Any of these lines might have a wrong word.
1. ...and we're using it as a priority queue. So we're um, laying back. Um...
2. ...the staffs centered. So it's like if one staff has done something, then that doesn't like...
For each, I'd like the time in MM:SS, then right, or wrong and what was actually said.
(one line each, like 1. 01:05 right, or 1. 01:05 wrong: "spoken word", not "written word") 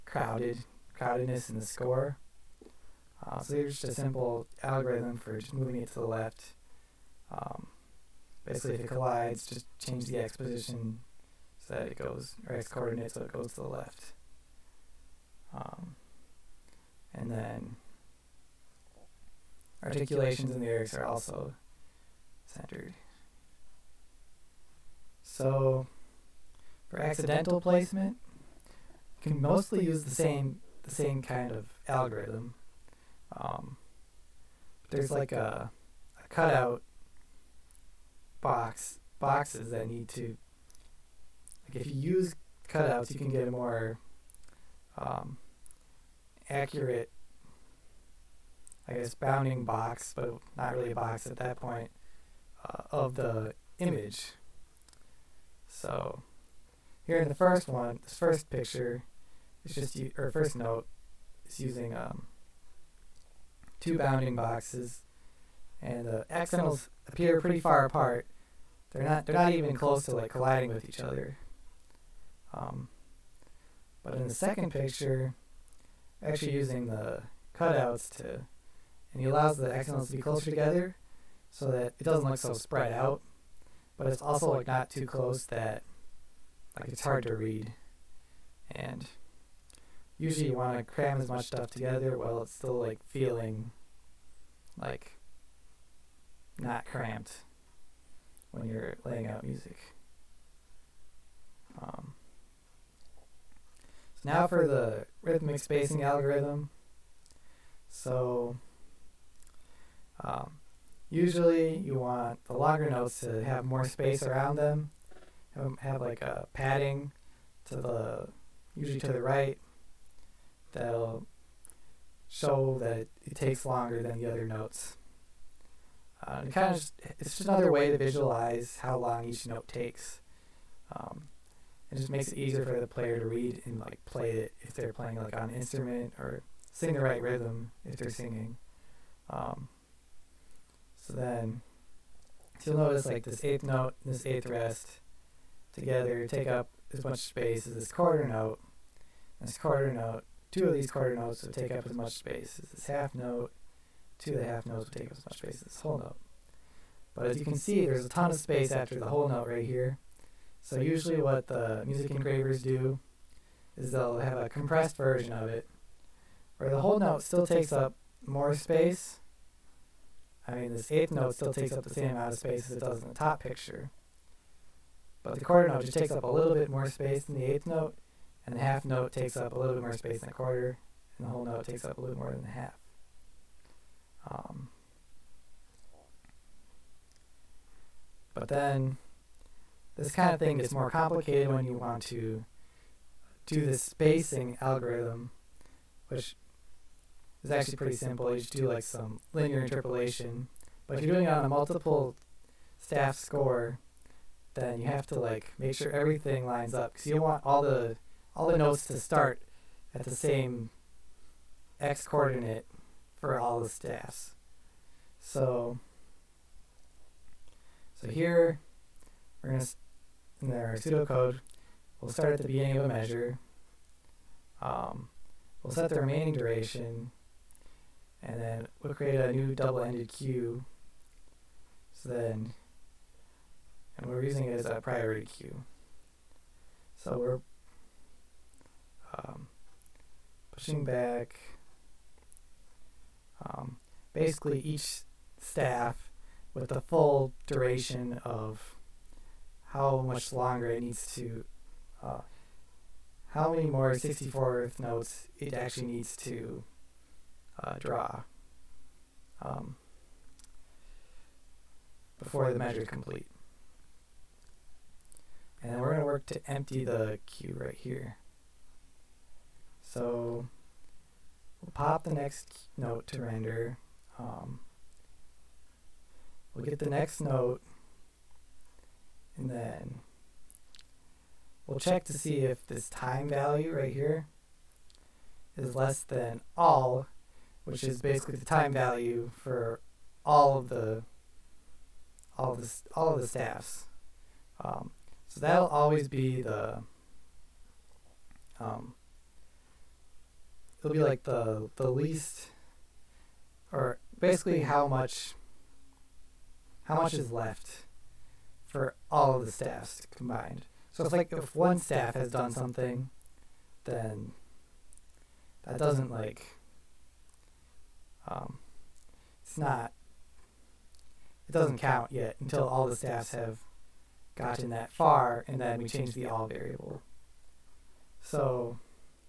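1. 03:53 wrong: "pushing", not "laying"
2. 05:09 wrong: "combined", not "centered".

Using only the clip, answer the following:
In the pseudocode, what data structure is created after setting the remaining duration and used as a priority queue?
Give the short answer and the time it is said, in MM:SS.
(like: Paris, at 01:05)
double-ended queue, at 03:49.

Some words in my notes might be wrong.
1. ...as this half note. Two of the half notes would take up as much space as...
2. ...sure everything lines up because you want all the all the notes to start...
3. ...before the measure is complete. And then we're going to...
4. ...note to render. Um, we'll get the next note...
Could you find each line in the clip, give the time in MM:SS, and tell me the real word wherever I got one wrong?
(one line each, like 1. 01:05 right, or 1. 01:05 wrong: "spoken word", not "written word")
1. 02:32 right
2. 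03:25 right
3. 04:22 right
4. 04:32 right.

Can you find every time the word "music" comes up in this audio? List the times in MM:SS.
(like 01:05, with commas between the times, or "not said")
01:39, 02:41.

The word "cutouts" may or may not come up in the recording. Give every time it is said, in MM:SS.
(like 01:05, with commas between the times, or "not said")
00:36, 00:42, 01:17.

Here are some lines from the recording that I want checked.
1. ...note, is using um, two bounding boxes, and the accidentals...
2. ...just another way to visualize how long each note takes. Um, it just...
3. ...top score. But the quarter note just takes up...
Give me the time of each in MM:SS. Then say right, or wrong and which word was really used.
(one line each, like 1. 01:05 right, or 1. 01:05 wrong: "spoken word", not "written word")
1. 01:00 right
2. 02:07 right
3. 02:53 wrong: "picture", not "score".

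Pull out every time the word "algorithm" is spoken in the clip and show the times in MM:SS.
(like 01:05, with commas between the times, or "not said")
00:04, 00:31, 01:46, 03:14.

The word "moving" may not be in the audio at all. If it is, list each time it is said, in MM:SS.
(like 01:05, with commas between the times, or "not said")
00:05.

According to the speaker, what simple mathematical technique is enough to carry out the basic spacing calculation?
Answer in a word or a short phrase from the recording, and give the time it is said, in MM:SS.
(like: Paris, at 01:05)
linear interpolation, at 03:19.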